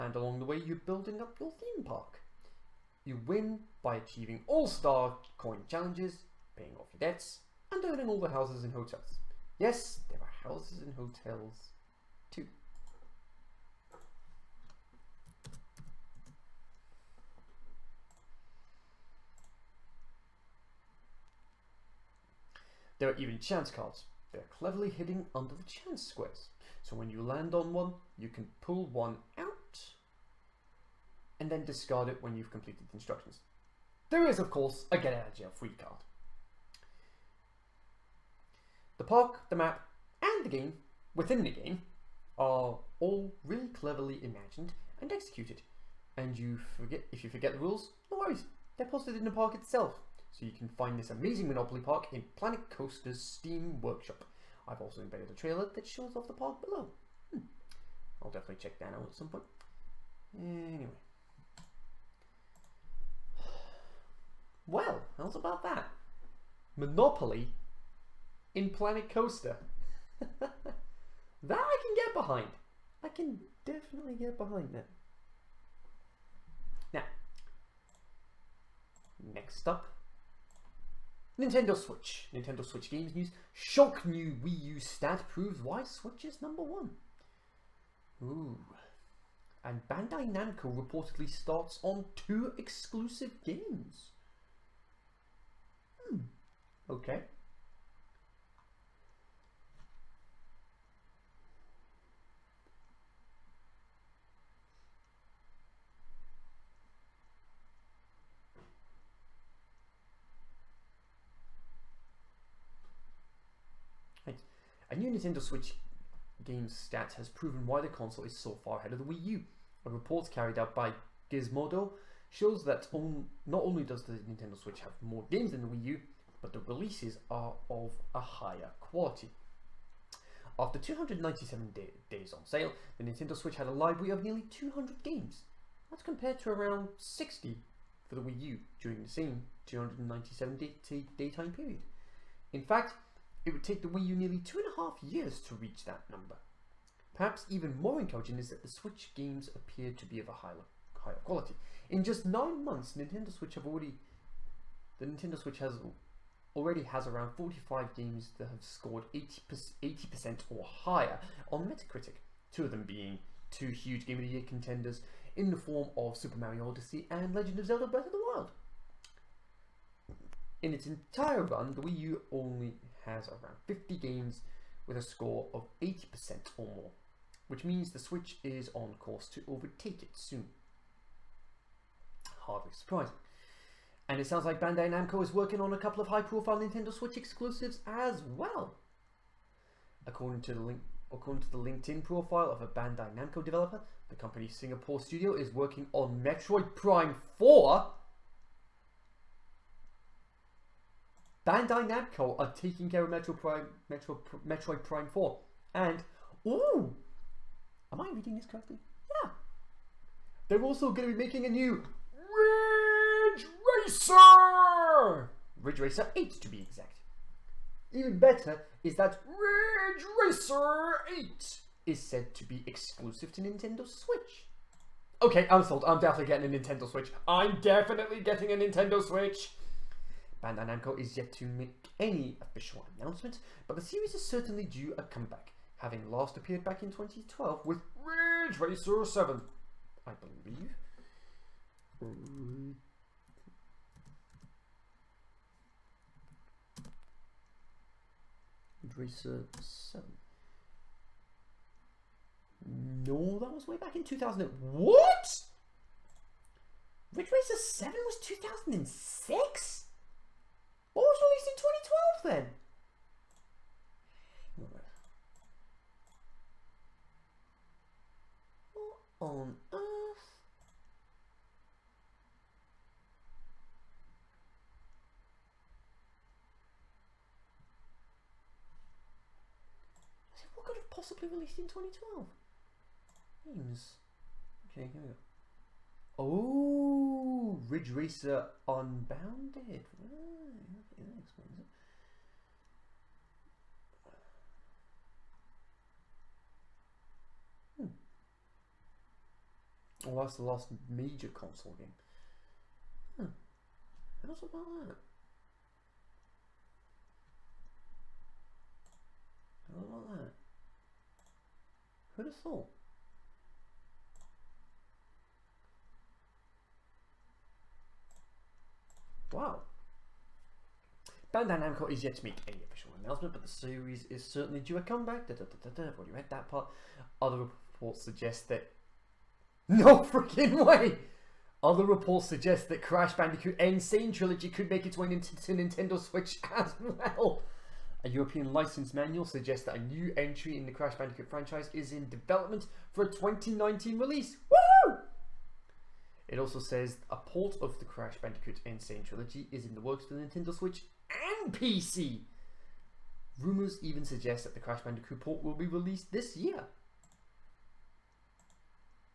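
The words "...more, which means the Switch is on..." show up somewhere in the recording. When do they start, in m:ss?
2:56.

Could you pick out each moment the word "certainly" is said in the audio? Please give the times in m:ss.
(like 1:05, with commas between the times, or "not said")
3:54, 5:24.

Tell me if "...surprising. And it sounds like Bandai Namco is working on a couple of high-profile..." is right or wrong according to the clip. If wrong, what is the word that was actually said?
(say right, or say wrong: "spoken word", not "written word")
right.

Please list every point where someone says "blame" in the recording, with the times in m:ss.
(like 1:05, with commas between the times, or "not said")
not said.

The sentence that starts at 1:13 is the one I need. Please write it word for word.
I can definitely get behind that.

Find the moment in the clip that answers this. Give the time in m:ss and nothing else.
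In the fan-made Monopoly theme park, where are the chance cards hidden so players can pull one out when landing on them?
0:25.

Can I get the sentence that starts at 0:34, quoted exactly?
There is, of course, a get out of jail free card.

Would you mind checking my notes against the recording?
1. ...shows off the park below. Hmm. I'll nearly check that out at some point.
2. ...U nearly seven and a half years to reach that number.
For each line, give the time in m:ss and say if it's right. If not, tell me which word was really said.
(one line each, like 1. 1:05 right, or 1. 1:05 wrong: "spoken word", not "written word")
1. 0:55 wrong: "definitely", not "nearly"
2. 2:24 wrong: "two", not "seven".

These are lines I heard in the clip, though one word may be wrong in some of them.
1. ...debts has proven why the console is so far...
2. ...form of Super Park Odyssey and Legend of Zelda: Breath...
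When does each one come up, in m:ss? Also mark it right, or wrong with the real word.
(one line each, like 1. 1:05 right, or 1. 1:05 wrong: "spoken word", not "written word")
1. 1:56 wrong: "stats", not "debts"
2. 2:45 wrong: "Mario", not "Park".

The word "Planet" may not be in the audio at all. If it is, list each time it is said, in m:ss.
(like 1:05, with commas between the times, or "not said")
0:52, 1:08.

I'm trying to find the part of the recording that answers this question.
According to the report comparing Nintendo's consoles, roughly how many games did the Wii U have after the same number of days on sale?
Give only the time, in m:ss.
2:16.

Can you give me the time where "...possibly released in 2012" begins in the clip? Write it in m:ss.
4:40.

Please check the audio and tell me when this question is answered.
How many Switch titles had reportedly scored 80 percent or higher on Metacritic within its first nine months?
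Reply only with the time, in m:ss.
2:37.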